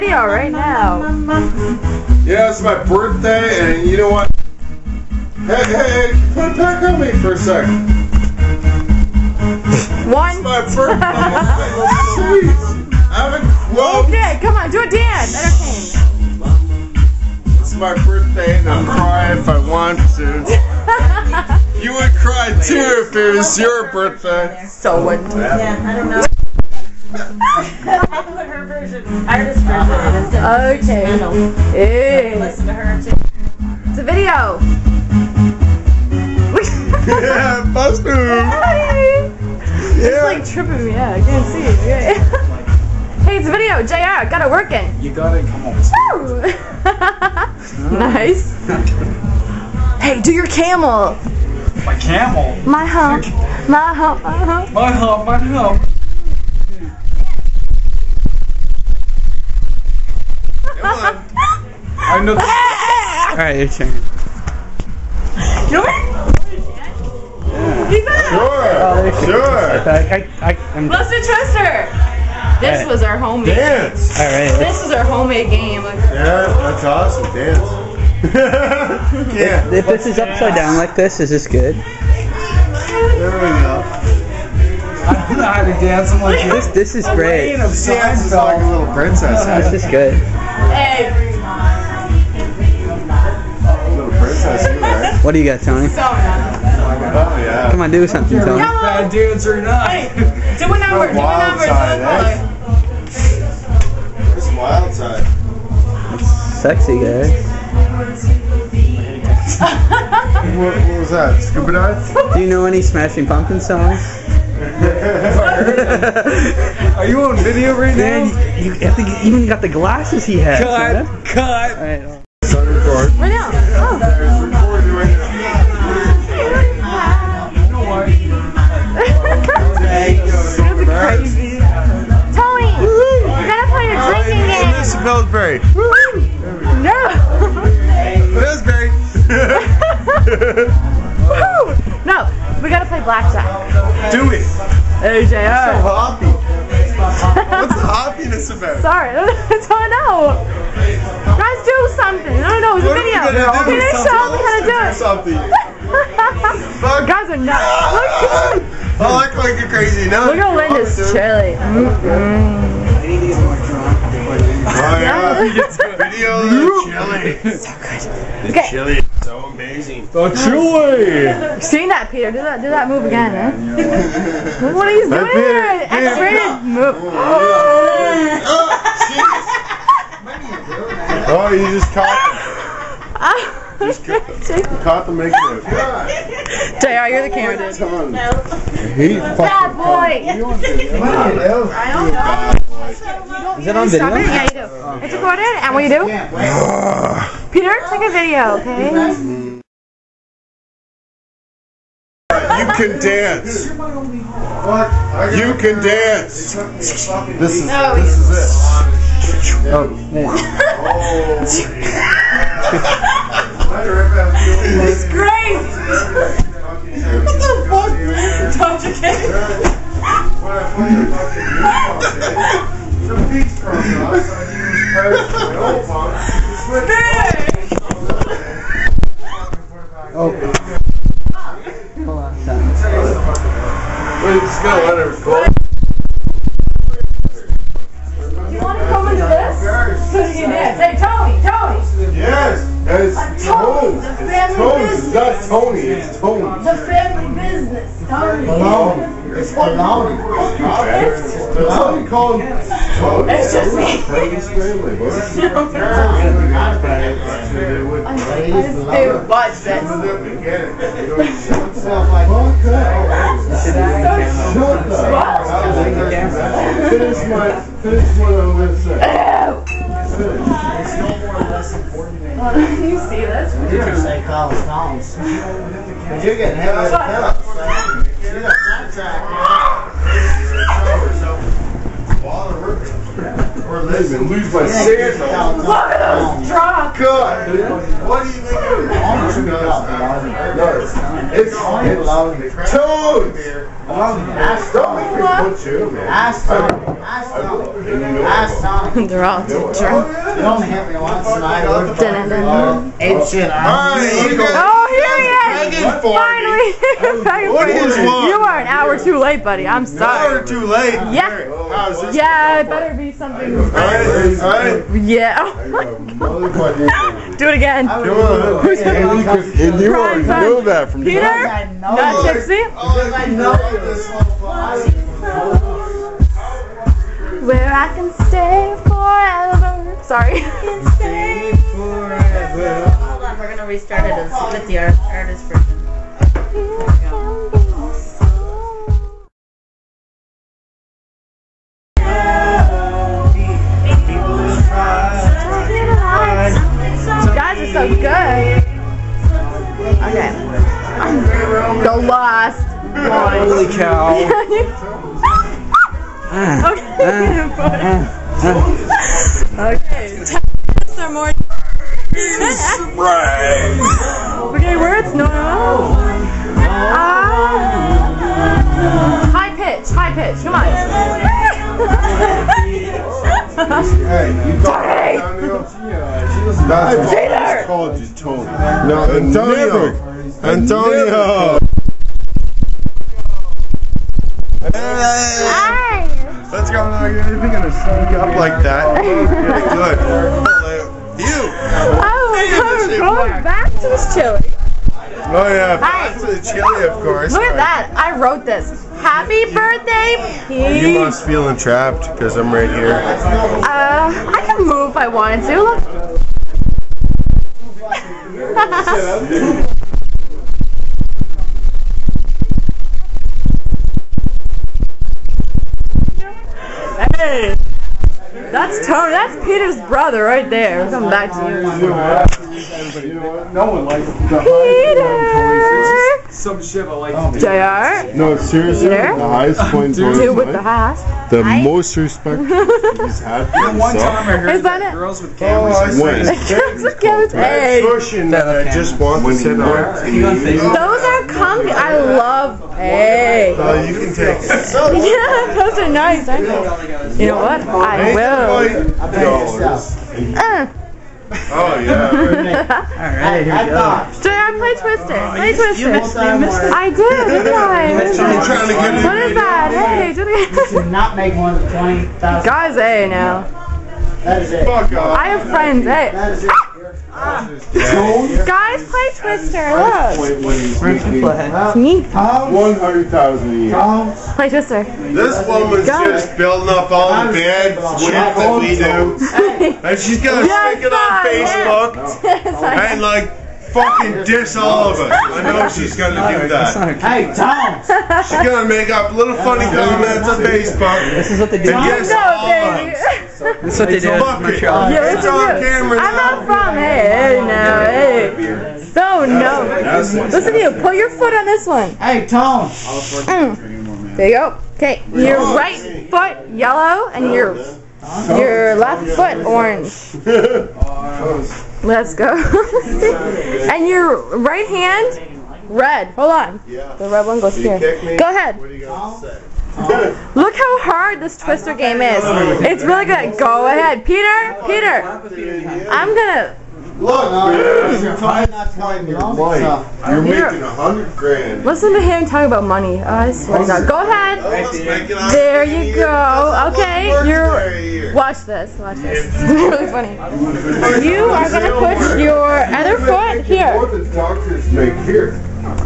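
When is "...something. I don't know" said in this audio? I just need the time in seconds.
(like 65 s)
151 s.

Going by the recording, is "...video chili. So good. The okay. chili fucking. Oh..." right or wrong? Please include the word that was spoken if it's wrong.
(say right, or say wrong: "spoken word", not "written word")
wrong: "amazing", not "fucking".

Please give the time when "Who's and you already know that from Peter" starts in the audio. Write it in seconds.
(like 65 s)
317 s.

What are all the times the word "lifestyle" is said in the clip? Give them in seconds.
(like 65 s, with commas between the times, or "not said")
not said.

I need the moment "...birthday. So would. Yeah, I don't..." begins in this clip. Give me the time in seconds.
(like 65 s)
23 s.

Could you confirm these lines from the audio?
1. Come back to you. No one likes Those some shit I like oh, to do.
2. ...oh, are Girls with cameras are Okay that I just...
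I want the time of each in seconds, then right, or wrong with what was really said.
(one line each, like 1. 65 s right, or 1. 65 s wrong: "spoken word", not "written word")
1. 420 s wrong: "Peter", not "Those"
2. 435 s wrong: "Cushion", not "Okay".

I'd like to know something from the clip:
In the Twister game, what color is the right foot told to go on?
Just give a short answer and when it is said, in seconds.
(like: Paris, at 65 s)
Yellow, at 506 s.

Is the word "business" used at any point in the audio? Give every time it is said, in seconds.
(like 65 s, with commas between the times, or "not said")
247 s.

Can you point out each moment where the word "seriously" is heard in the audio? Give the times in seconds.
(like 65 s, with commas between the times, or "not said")
428 s.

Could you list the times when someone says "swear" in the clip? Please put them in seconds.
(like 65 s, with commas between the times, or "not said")
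533 s.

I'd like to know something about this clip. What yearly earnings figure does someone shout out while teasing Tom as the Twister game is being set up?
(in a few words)
100,000 a year.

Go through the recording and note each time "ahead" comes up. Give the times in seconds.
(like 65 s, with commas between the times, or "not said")
518 s, 523 s, 534 s.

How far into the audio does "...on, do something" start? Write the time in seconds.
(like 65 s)
97 s.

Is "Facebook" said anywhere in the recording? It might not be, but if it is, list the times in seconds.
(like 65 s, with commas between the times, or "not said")
481 s, 490 s.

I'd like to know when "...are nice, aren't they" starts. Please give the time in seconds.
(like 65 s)
445 s.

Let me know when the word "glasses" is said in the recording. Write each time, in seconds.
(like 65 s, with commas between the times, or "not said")
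119 s.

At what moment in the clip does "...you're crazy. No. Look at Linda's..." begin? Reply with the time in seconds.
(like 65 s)
159 s.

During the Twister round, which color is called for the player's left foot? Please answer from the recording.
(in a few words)
Orange.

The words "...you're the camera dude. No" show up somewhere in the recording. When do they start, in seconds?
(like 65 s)
187 s.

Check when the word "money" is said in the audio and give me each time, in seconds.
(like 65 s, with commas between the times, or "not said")
532 s.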